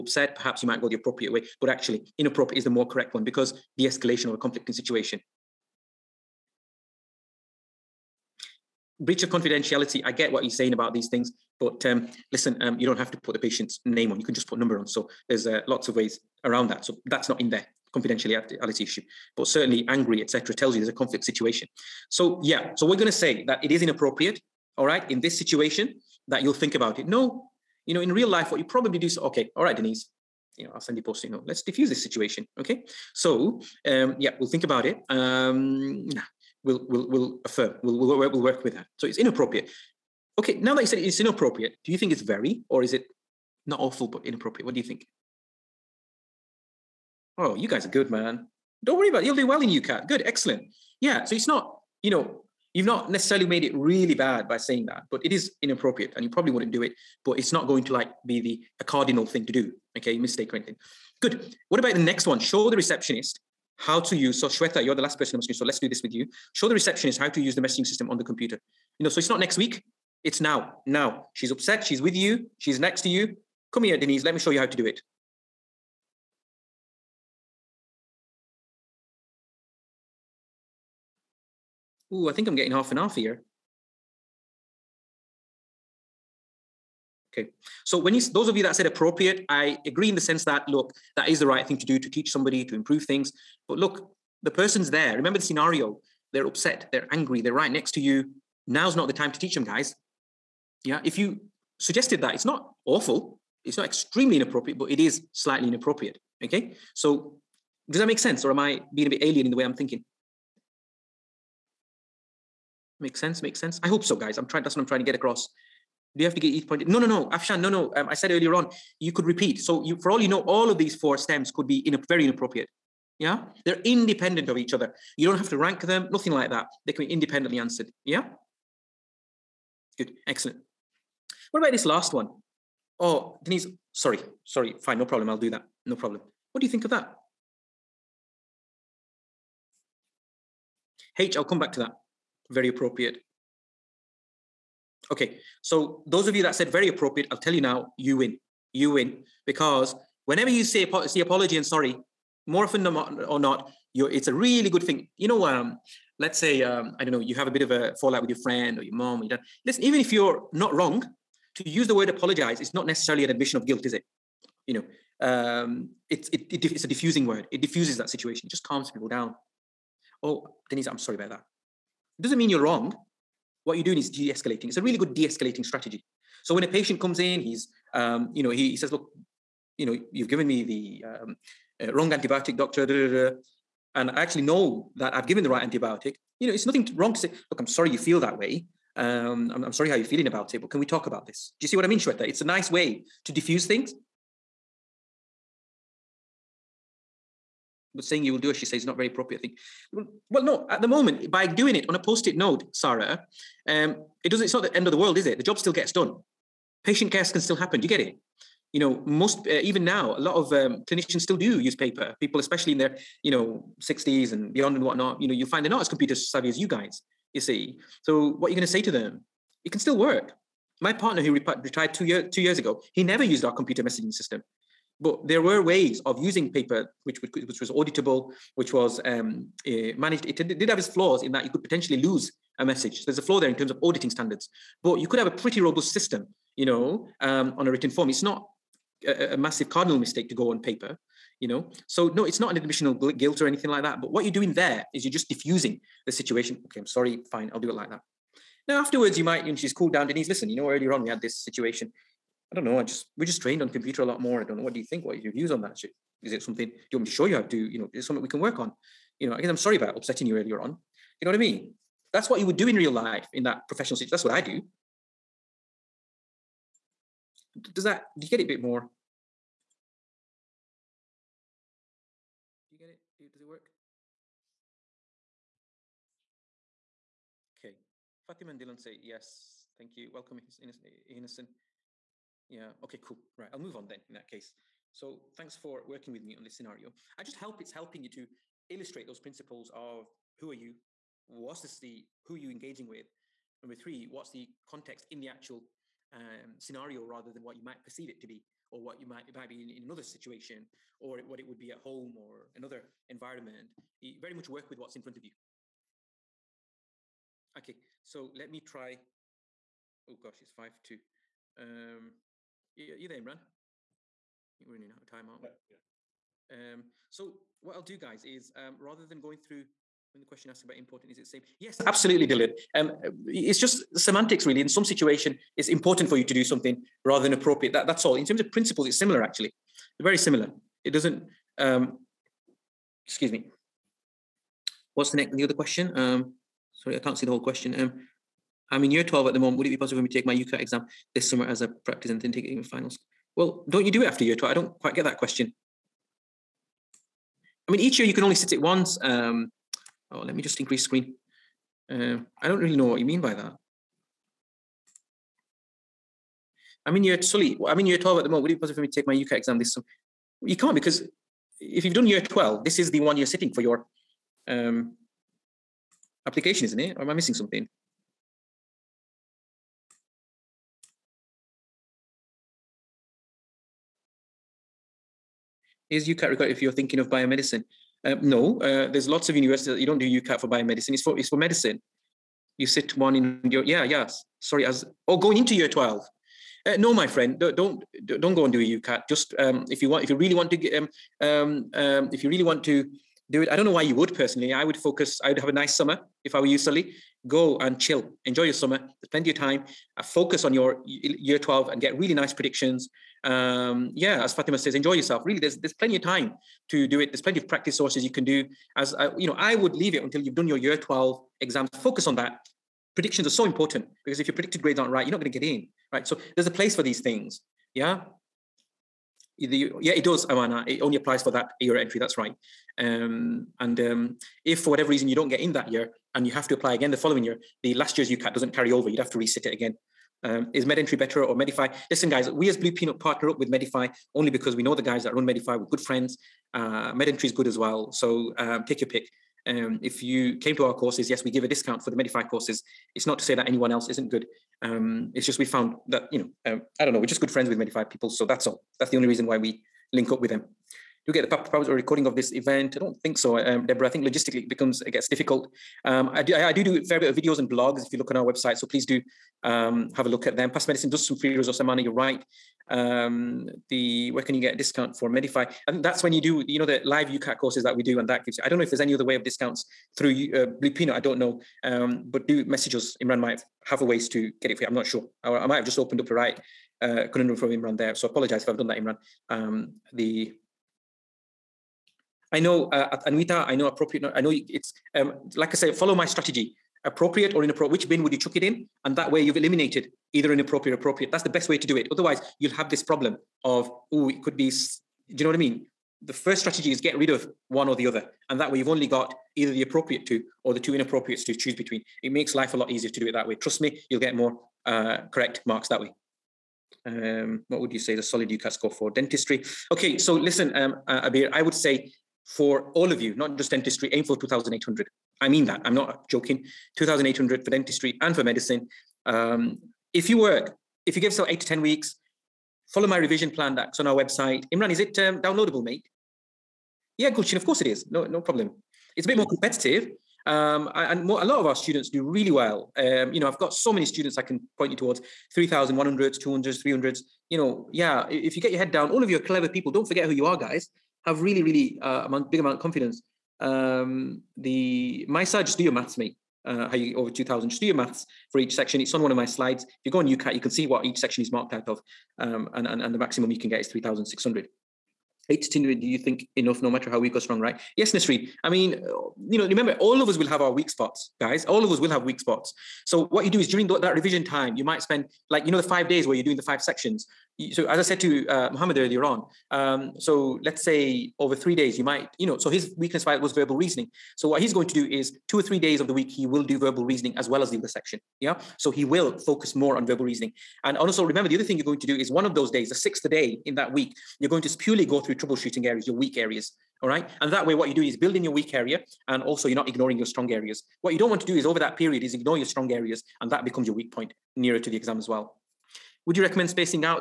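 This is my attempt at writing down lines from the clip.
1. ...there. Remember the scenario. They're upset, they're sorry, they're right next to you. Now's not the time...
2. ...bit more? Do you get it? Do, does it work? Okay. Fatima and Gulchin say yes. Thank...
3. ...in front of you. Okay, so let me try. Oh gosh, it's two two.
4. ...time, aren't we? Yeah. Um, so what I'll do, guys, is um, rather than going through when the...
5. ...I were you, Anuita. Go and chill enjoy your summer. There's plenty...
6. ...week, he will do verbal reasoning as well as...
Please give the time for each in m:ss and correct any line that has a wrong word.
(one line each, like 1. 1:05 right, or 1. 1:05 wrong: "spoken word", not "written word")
1. 1:34 wrong: "angry", not "sorry"
2. 4:28 wrong: "Dylan", not "Gulchin"
3. 5:04 wrong: "five", not "two"
4. 5:15 right
5. 6:36 wrong: "Sully", not "Anuita"
6. 9:35 right.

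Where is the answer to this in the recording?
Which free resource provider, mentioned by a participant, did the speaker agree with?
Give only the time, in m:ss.
7:40.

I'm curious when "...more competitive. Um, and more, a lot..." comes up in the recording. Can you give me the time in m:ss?
8:49.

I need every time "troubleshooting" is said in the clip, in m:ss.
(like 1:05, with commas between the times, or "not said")
9:45.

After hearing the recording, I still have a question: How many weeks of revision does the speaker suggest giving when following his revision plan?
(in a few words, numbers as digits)
8 to 10 weeks.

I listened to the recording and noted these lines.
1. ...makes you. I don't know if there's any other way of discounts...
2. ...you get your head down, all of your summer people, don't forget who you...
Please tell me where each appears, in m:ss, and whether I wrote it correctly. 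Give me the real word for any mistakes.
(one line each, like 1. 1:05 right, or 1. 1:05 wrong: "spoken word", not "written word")
1. 7:48 wrong: "gives", not "makes"
2. 8:58 wrong: "clever", not "summer".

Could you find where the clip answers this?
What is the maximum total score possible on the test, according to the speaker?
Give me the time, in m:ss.
9:13.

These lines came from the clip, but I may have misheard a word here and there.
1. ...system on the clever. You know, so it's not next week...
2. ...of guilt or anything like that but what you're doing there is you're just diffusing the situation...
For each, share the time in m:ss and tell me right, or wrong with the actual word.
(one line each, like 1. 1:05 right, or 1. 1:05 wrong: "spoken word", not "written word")
1. 1:07 wrong: "computer", not "clever"
2. 4:02 right.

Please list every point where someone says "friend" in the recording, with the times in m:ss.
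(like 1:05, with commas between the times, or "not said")
2:38, 6:27, 7:15, 7:27.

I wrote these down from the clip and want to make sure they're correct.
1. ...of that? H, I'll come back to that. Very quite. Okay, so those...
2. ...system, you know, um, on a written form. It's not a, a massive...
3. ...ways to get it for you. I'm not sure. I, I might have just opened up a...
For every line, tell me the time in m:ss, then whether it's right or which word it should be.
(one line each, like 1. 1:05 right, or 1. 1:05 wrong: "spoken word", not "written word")
1. 2:16 wrong: "appropriate", not "quite"
2. 3:55 right
3. 7:53 right.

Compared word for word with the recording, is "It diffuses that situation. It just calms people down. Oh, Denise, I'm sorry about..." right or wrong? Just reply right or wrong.
right.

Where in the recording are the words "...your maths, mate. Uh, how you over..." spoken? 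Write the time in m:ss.
9:05.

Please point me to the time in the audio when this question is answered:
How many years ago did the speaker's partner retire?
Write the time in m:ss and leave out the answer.
3:42.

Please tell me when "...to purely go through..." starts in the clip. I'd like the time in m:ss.
9:44.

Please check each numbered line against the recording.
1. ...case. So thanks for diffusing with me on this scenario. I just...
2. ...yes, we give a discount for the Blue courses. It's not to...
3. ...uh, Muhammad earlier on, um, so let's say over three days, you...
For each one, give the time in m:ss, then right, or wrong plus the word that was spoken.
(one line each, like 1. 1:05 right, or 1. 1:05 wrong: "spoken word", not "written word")
1. 4:44 wrong: "working", not "diffusing"
2. 7:21 wrong: "Medify", not "Blue"
3. 9:28 right.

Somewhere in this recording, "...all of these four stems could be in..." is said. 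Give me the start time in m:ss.
2:00.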